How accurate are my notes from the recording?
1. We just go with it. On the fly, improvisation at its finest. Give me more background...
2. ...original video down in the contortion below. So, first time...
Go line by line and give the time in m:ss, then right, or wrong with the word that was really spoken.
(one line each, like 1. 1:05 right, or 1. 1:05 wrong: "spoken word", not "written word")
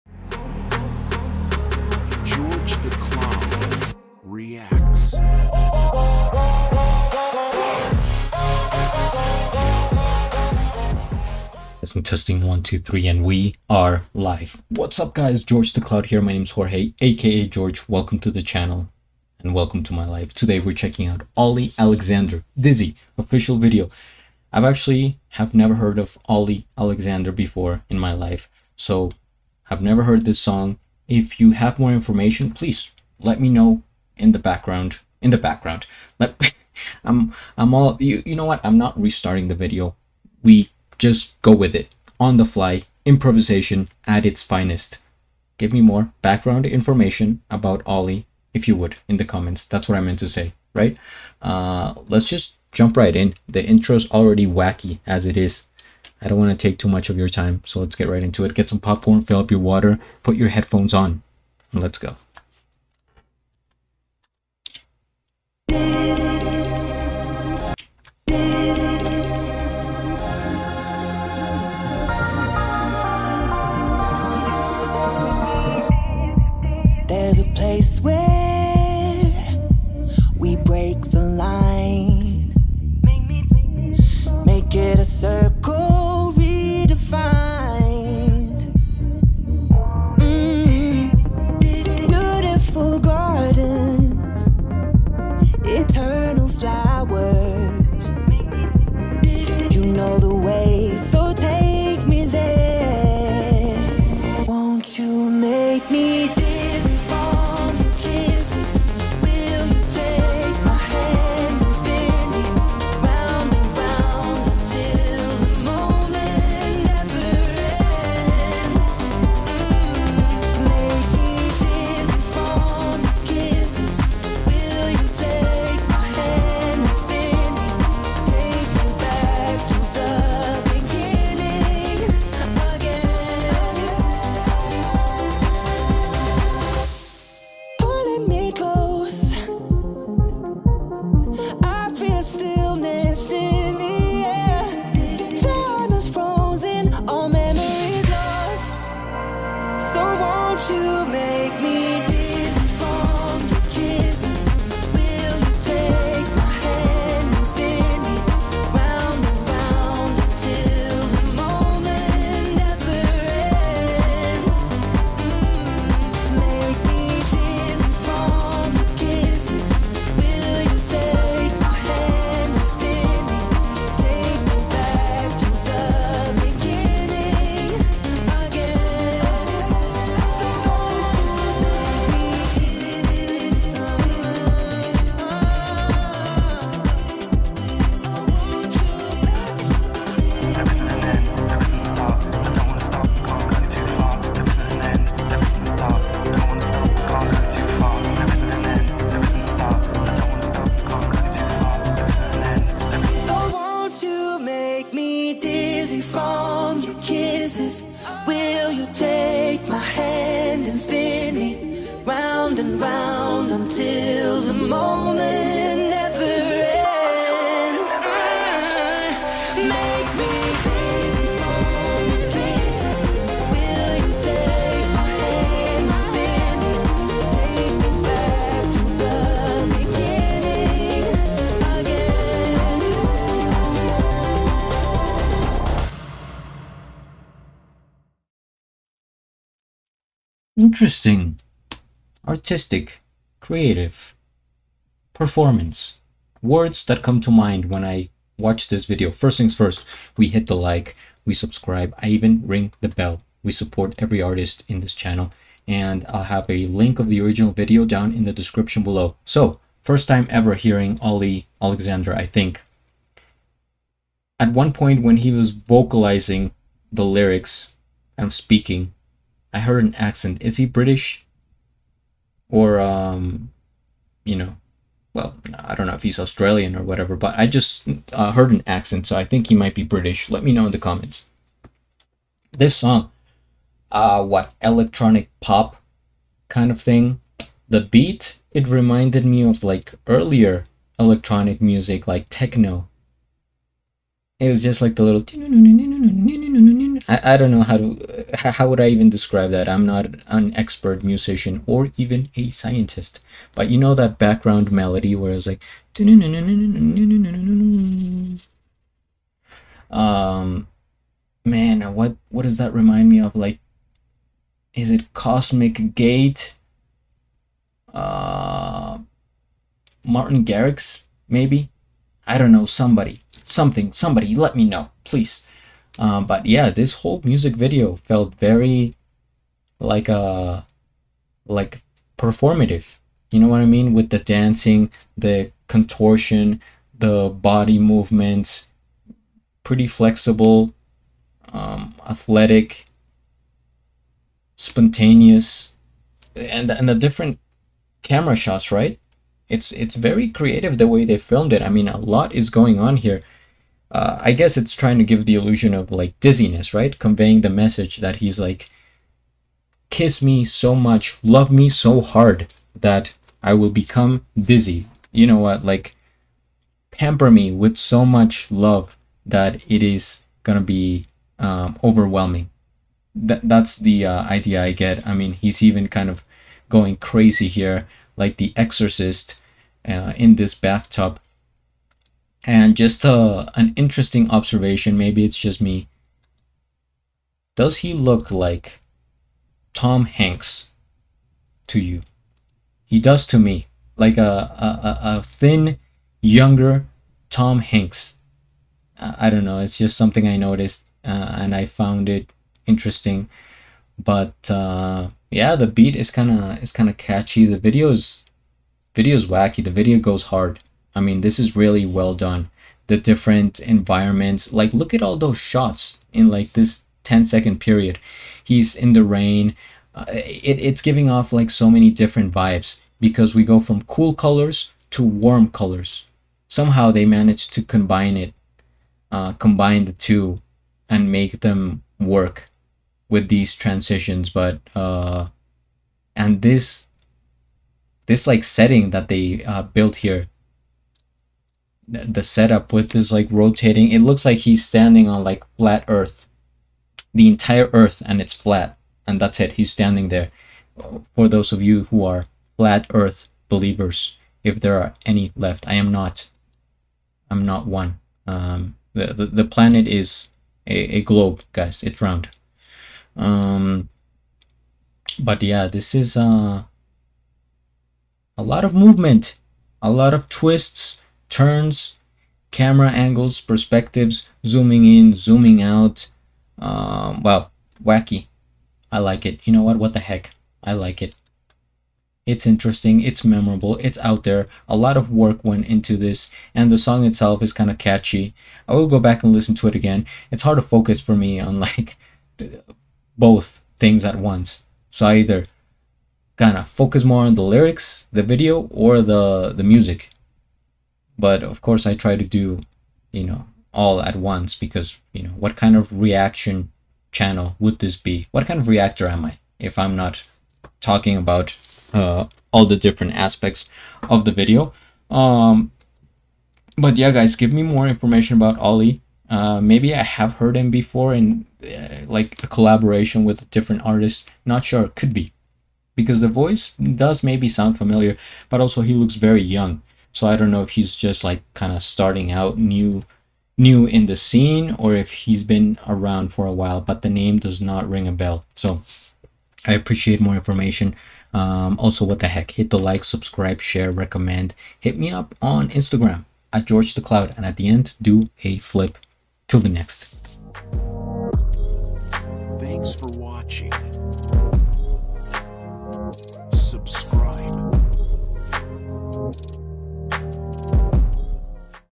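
1. 0:40 right
2. 4:17 wrong: "description", not "contortion".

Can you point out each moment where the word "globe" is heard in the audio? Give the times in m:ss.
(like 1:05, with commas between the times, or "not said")
7:41.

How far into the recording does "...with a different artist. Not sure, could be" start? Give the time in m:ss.
8:43.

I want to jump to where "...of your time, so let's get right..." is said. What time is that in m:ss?
0:57.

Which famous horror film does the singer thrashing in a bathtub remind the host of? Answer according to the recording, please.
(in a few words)
The Exorcist.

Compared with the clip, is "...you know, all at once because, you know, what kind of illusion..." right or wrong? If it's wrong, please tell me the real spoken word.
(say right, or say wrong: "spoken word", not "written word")
wrong: "reaction", not "illusion".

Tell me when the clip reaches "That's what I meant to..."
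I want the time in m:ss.
0:49.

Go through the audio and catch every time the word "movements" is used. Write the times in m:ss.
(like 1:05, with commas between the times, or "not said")
5:37, 7:48.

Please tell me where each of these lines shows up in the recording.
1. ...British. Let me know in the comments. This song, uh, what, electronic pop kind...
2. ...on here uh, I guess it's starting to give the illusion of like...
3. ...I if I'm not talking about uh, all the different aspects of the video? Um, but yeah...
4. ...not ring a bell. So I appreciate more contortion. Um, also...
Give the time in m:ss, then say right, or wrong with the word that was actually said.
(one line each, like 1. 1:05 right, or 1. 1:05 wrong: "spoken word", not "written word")
1. 4:39 right
2. 5:52 wrong: "trying", not "starting"
3. 8:29 right
4. 8:57 wrong: "information", not "contortion".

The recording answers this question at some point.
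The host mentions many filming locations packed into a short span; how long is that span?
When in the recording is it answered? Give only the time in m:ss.
6:57.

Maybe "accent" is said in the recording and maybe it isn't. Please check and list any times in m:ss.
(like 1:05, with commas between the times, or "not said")
4:29, 4:38.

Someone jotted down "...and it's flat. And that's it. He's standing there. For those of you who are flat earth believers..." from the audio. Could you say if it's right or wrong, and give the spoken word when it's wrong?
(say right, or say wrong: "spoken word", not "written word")
right.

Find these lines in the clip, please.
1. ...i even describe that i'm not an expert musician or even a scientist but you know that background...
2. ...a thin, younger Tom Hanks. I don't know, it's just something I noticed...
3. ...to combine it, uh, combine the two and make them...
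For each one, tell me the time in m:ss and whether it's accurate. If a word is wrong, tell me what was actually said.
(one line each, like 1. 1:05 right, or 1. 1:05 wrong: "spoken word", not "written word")
1. 4:58 right
2. 6:35 right
3. 7:07 right.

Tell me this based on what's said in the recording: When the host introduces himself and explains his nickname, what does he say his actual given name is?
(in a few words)
Jorge.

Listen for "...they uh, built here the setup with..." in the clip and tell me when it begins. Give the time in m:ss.
7:19.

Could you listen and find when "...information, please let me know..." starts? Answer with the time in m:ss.
0:31.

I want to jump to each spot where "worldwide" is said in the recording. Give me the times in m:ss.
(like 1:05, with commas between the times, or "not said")
not said.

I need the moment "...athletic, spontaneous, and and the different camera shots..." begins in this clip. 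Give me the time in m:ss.
5:42.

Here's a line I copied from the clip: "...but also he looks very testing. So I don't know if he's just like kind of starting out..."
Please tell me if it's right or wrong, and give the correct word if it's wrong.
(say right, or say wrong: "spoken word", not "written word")
wrong: "young", not "testing".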